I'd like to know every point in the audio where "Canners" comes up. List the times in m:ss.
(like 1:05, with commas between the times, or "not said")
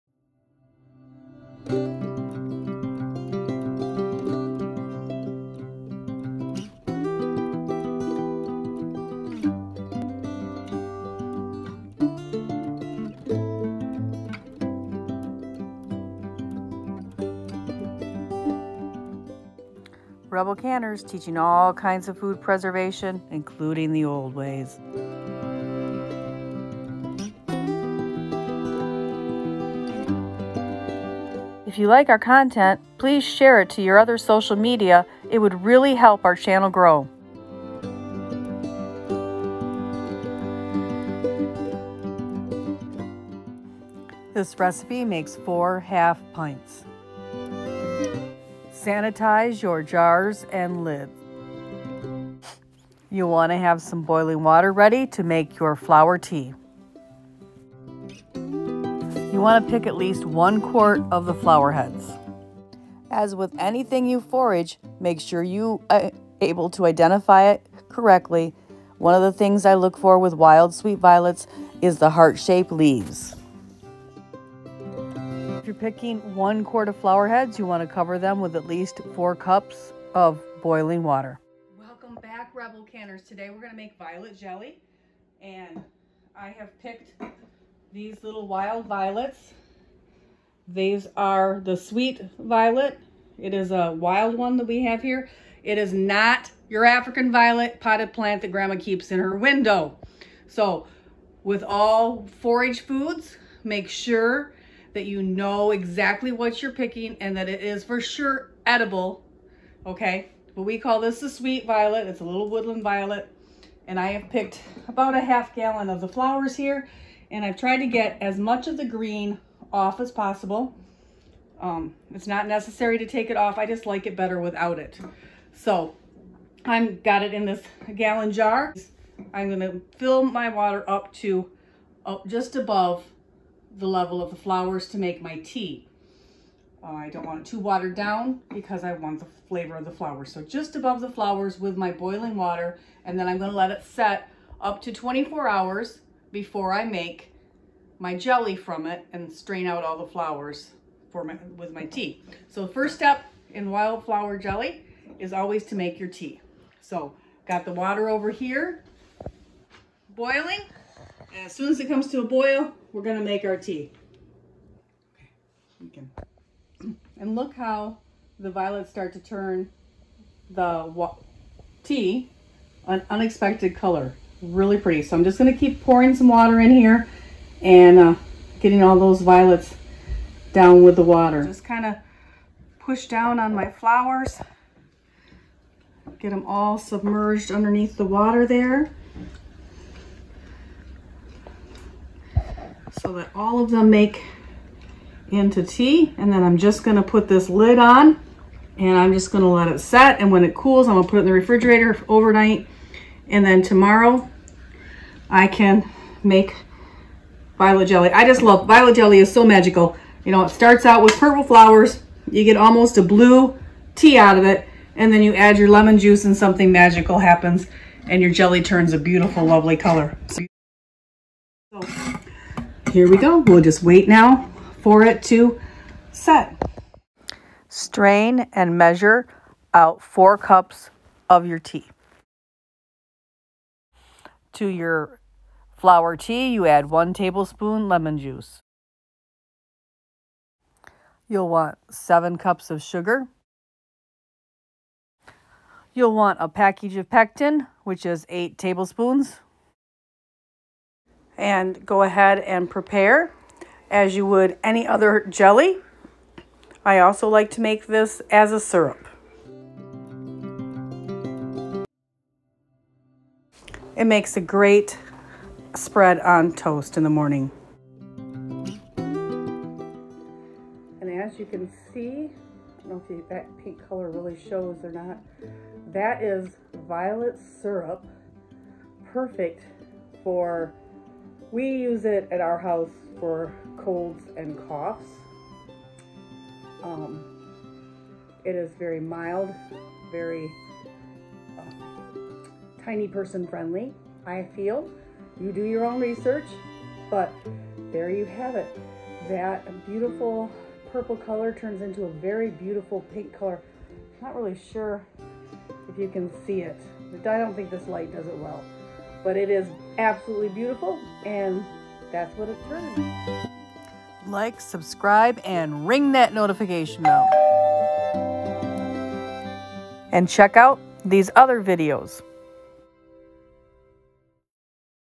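0:20, 1:22.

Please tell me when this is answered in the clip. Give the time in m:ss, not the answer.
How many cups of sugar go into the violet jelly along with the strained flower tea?
4:01.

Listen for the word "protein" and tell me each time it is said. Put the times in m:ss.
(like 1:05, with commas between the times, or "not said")
not said.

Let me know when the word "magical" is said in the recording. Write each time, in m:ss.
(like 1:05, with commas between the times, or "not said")
3:29, 3:36.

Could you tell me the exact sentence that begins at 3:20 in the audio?
And when it cools, I'm going to put it in the refrigerator overnight.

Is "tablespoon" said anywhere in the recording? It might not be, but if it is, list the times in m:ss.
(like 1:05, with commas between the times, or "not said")
3:57, 4:08.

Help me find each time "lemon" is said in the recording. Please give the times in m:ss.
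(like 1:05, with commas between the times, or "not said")
3:35, 3:57.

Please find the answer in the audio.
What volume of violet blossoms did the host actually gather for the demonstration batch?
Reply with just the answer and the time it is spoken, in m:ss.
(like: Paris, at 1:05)
half gallon, at 1:55.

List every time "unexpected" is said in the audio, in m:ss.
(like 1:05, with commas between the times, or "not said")
2:53.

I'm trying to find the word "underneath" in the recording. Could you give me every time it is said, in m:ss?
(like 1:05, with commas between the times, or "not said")
3:07.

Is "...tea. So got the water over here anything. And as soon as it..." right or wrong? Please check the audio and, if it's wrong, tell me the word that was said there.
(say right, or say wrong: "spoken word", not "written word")
wrong: "boiling", not "anything".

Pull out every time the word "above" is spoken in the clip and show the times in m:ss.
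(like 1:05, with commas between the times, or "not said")
2:12, 2:20.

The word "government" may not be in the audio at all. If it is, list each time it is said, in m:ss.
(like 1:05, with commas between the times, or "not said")
not said.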